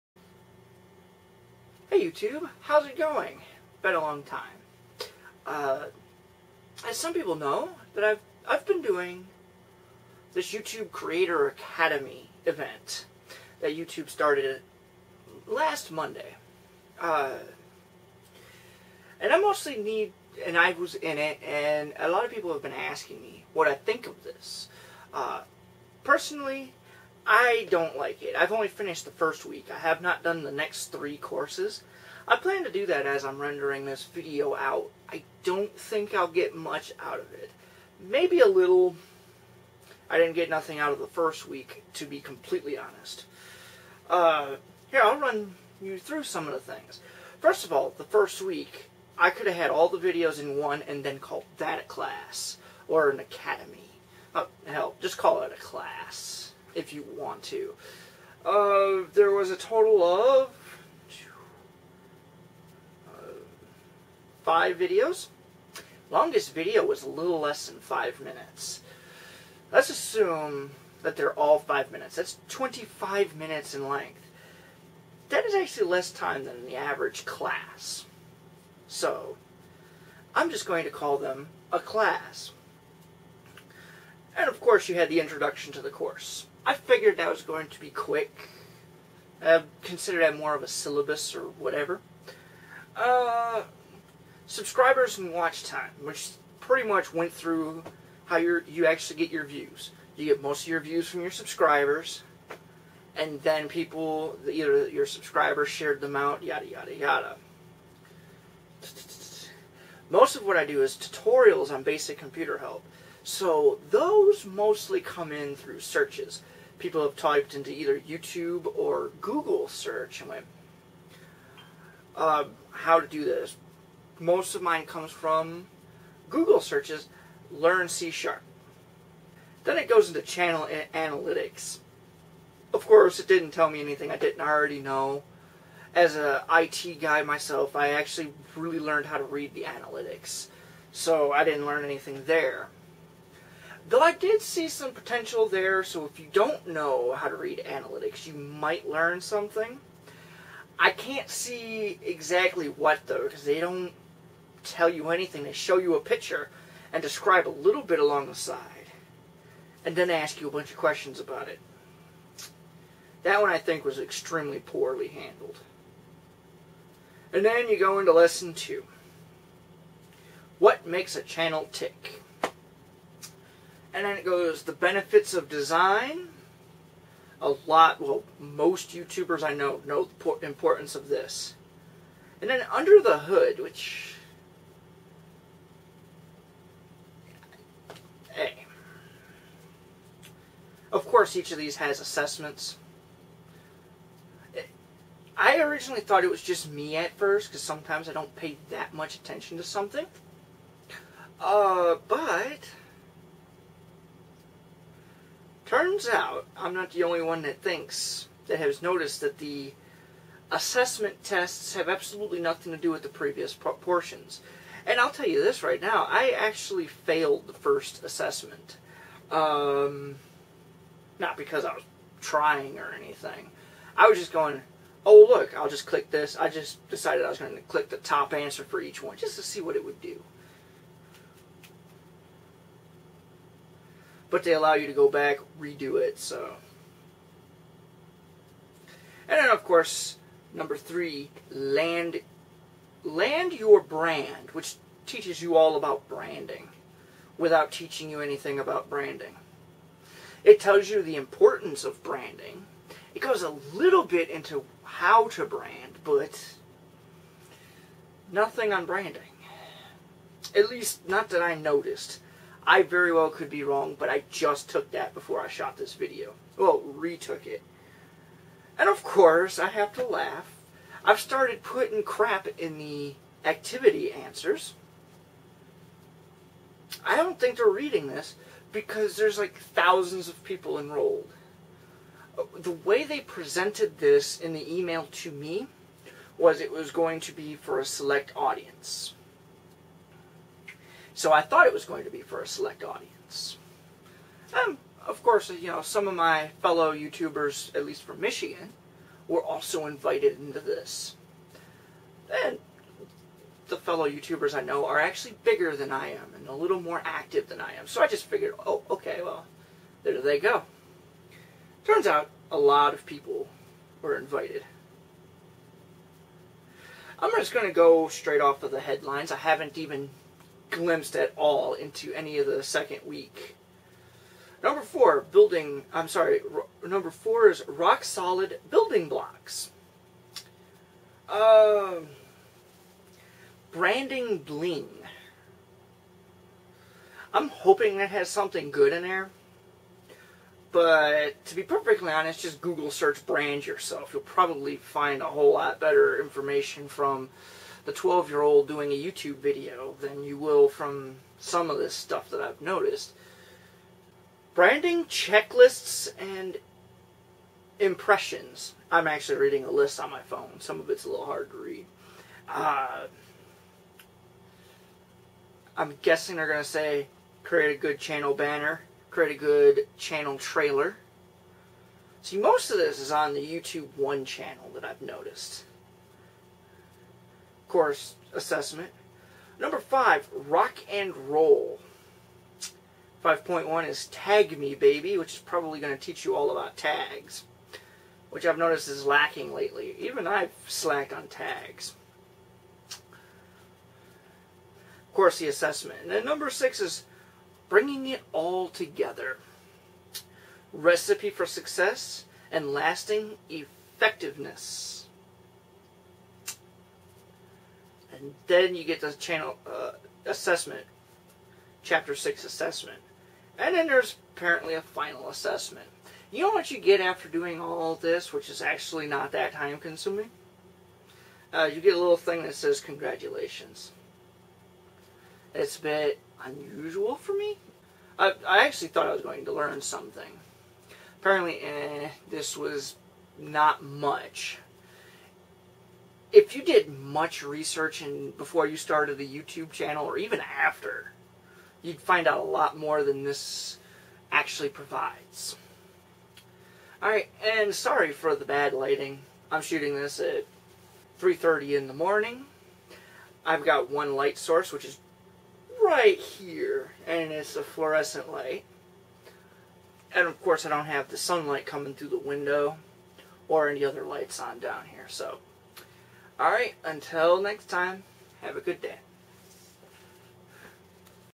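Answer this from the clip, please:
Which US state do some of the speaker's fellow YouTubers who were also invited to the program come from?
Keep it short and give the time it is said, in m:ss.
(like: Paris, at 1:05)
Michigan, at 4:58.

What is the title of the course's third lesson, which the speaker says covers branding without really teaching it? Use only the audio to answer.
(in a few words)
Land your brand.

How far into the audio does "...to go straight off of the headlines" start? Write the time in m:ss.
5:17.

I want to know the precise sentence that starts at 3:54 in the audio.
but they allow you to go back, redo it, so.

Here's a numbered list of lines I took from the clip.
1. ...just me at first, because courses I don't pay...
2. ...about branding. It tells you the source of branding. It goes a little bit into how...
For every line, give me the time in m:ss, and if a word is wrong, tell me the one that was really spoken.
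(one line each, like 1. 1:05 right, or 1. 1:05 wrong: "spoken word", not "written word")
1. 3:16 wrong: "sometimes", not "courses"
2. 4:08 wrong: "importance", not "source".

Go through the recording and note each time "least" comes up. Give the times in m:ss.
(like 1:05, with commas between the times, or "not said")
4:20, 4:57.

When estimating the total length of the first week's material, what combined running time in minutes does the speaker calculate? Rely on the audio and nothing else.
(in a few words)
25 minutes.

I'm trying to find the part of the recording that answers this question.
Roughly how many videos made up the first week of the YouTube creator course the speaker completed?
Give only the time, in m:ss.
1:04.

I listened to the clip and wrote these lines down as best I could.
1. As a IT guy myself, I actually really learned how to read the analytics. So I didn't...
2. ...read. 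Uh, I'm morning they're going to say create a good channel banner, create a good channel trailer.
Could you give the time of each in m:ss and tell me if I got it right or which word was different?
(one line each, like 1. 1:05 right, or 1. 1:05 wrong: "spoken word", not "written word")
1. 2:15 right
2. 6:01 wrong: "guessing", not "morning".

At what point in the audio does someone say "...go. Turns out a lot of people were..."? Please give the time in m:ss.
5:10.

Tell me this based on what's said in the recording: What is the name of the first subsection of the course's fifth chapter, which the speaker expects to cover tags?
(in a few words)
Tag Me Baby.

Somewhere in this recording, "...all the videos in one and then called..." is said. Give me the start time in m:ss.
0:49.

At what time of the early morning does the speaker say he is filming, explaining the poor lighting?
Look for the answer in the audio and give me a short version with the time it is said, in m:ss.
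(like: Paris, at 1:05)
3:30, at 7:31.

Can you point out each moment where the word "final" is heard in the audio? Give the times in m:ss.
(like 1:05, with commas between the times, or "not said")
6:54.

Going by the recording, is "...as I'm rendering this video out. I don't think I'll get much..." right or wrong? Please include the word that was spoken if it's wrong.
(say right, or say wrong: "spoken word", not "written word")
right.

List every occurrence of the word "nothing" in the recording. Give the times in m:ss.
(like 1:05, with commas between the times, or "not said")
0:40, 3:32, 4:18.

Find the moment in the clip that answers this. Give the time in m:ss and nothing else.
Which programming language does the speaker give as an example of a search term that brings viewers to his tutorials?
2:07.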